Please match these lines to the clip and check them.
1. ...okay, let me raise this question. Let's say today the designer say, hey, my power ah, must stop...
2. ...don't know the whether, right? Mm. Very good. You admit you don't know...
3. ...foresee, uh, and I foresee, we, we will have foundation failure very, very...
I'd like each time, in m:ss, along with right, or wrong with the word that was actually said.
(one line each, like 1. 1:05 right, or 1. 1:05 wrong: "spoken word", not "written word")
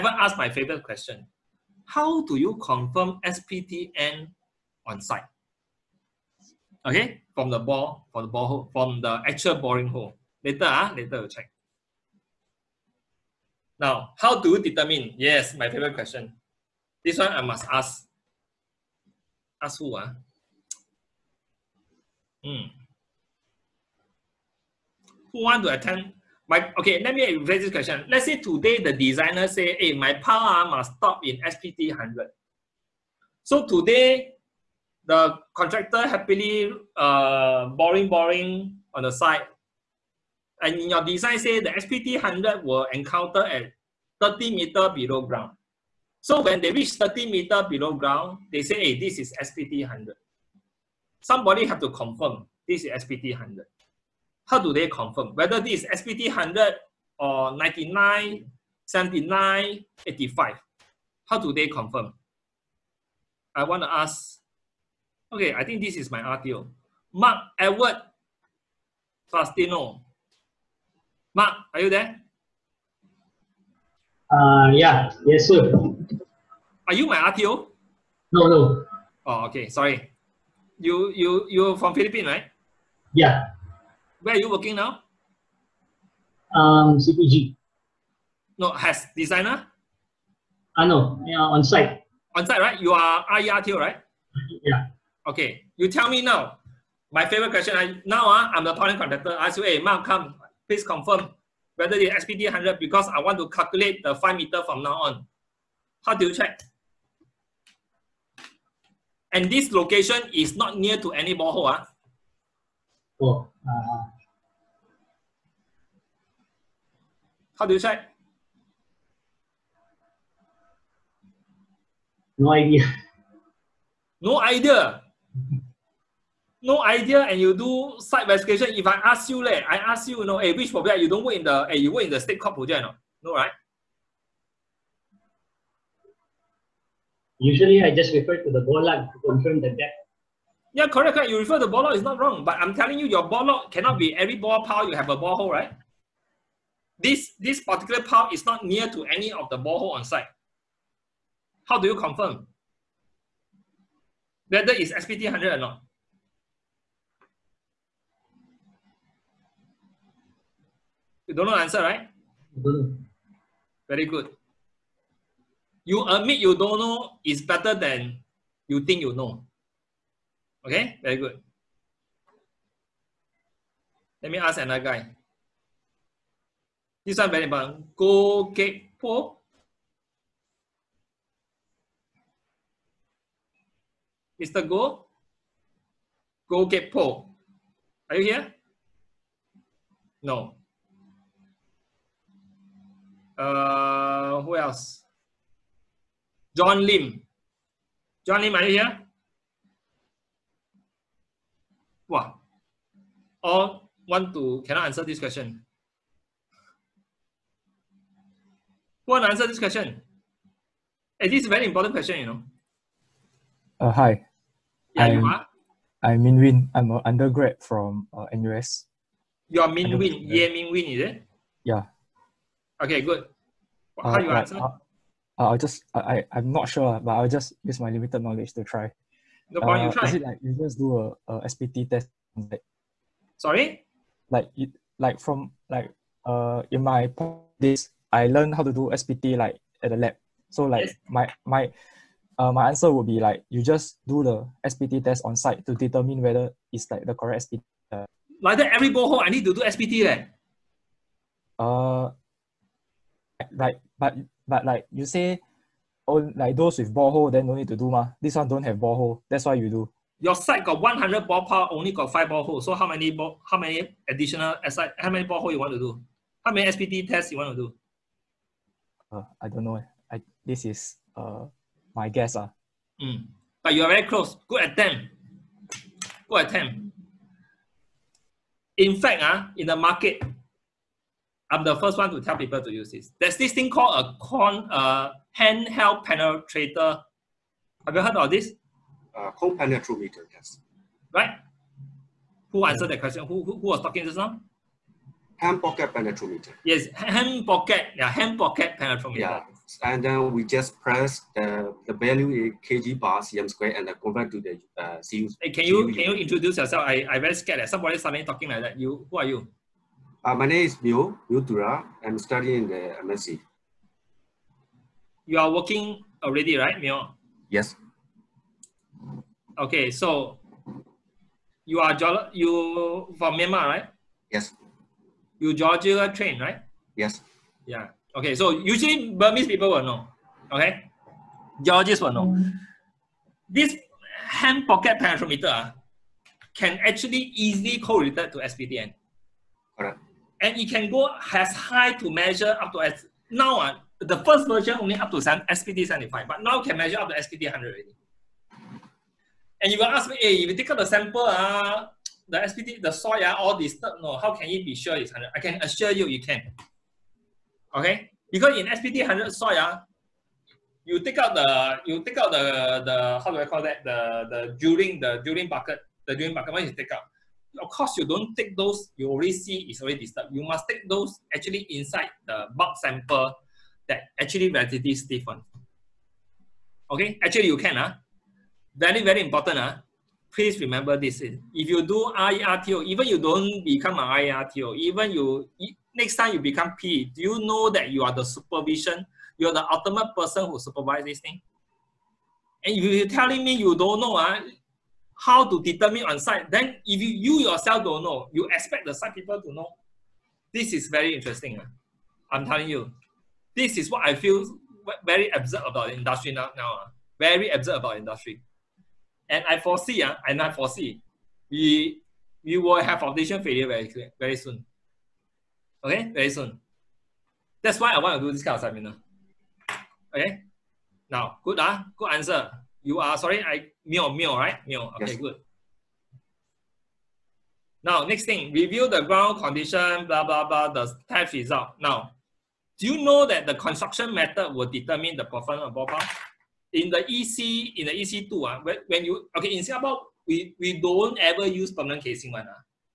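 1. 0:26 right
2. 2:41 wrong: "answer", not "whether"
3. 6:49 right.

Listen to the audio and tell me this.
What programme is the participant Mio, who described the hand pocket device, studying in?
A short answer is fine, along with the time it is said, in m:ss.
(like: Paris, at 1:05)
MSc, at 5:13.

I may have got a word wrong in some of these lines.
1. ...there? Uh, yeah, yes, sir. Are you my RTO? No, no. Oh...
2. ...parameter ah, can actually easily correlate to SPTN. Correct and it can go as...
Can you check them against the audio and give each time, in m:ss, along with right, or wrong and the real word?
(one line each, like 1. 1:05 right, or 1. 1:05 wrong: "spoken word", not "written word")
1. 1:11 right
2. 5:34 right.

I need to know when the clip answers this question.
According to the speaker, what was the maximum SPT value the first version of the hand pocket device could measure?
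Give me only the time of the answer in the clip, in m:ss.
5:45.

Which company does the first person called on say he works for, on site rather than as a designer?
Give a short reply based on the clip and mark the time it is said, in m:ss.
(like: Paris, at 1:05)
CPG, at 1:26.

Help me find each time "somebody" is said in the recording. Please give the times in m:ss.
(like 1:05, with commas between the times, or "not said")
0:51, 5:07.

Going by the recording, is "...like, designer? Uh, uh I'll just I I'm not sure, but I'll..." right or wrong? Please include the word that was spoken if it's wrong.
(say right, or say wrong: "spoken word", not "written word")
wrong: "answer", not "designer".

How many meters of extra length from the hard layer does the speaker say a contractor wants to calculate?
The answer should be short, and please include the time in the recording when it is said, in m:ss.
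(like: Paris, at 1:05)
5 meters, at 1:44.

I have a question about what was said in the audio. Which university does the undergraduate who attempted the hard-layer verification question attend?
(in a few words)
NUS.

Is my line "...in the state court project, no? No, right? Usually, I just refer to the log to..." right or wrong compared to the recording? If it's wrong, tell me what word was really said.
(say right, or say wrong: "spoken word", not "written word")
right.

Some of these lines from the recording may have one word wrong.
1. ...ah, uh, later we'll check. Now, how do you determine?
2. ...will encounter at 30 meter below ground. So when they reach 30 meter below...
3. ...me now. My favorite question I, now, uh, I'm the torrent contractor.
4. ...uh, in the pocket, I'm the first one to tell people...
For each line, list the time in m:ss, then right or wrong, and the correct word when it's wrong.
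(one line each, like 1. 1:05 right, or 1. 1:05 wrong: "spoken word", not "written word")
1. 0:10 right
2. 0:42 right
3. 1:36 right
4. 4:39 wrong: "market", not "pocket".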